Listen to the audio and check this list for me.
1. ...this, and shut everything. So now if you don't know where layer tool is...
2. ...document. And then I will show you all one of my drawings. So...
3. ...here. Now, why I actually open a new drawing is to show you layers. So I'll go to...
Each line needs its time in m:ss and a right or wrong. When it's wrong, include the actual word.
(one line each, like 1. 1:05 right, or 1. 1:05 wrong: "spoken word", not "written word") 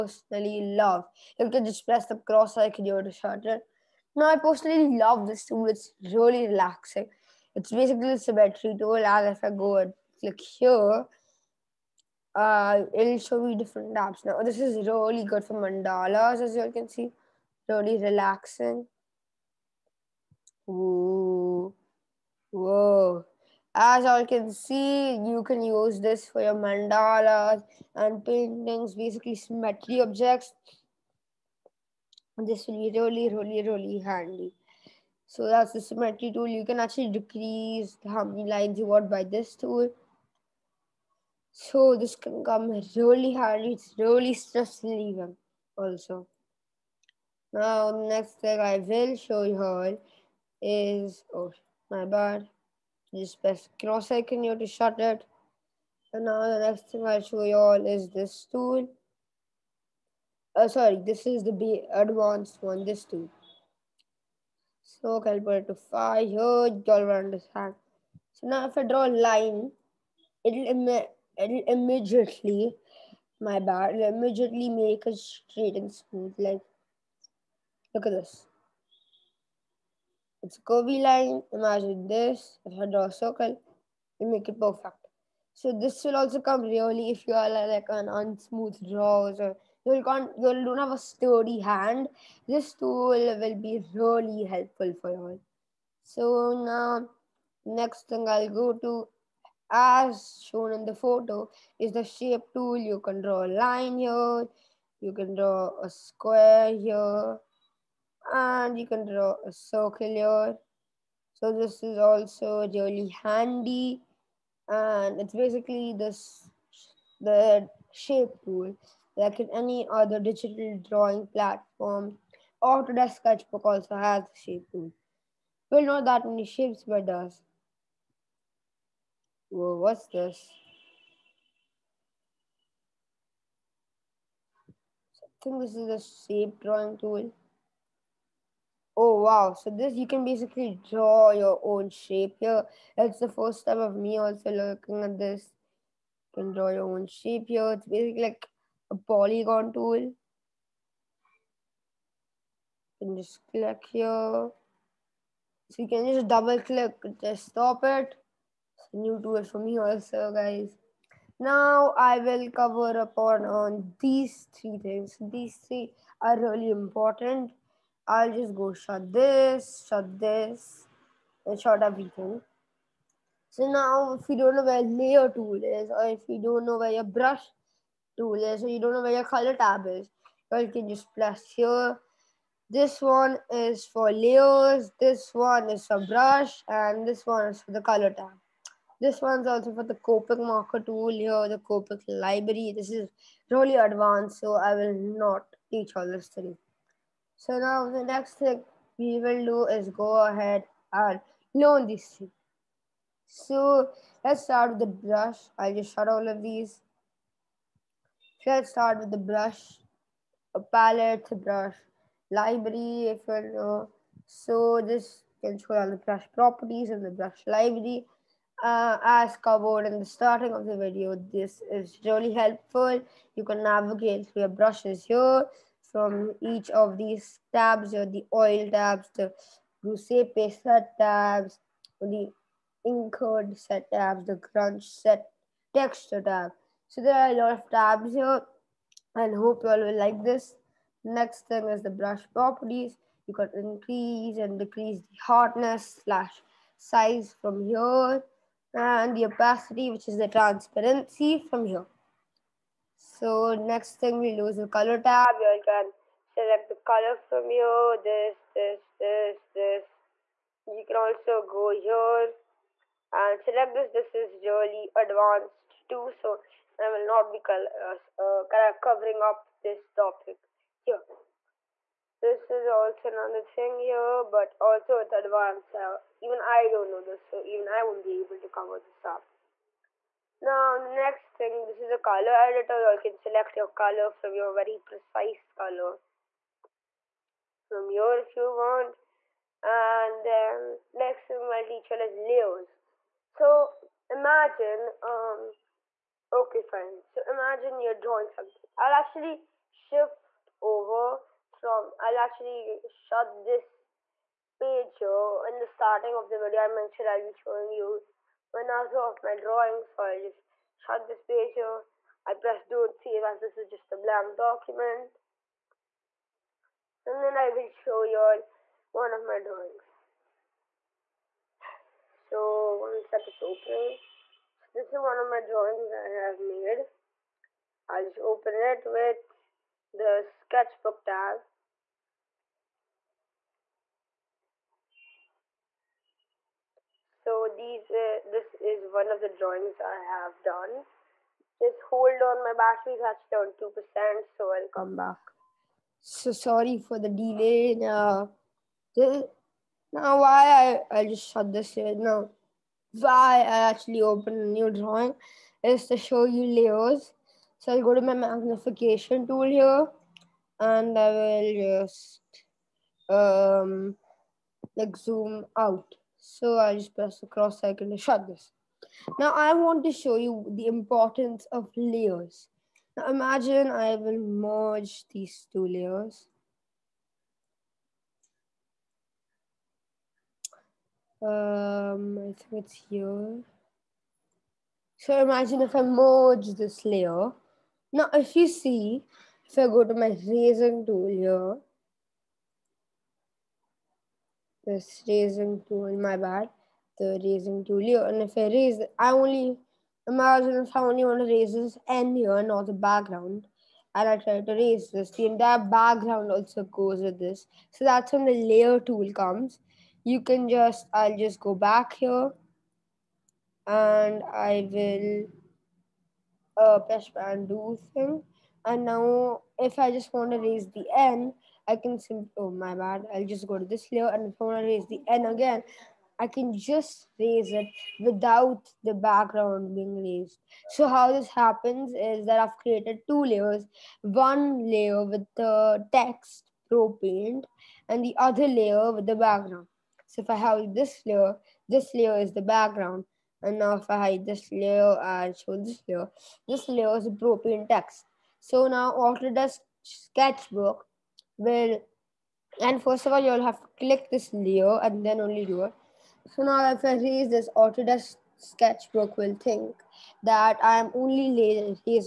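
1. 2:50 right
2. 5:14 right
3. 5:51 right.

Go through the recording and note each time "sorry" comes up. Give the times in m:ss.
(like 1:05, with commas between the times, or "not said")
1:00, 5:46.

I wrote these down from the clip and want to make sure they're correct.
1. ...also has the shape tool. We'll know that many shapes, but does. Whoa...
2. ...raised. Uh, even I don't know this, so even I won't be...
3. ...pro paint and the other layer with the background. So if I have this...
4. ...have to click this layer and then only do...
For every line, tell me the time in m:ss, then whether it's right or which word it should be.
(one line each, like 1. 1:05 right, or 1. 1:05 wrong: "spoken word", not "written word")
1. 2:03 right
2. 4:35 wrong: "advanced", not "raised"
3. 7:16 right
4. 7:33 right.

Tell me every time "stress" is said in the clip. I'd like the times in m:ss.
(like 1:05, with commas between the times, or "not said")
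0:44.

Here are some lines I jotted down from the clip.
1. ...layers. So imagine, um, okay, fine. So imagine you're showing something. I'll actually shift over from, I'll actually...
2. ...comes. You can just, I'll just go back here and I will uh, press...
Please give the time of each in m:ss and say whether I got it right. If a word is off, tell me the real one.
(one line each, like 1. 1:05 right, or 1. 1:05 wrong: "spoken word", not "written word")
1. 4:52 wrong: "drawing", not "showing"
2. 6:49 right.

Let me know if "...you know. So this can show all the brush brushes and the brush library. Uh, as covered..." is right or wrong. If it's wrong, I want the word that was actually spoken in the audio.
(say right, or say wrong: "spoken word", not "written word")
wrong: "properties", not "brushes".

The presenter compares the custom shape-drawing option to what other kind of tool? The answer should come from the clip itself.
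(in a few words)
Polygon tool.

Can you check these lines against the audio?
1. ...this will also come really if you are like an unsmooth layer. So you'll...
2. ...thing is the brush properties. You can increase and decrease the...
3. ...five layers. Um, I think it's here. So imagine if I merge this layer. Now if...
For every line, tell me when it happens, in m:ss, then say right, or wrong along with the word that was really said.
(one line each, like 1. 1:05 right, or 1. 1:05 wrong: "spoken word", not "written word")
1. 1:25 wrong: "drawer", not "layer"
2. 4:01 right
3. 6:15 wrong: "two", not "five".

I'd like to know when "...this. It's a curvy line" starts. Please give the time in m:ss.
1:18.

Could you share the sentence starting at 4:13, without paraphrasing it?
So next thing we lose the color tab.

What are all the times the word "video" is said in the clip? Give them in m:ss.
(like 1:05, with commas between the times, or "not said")
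3:40, 5:06.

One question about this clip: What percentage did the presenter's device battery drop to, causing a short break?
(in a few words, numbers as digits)
2%.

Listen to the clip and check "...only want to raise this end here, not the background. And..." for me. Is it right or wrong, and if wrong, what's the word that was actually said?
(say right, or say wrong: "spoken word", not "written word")
right.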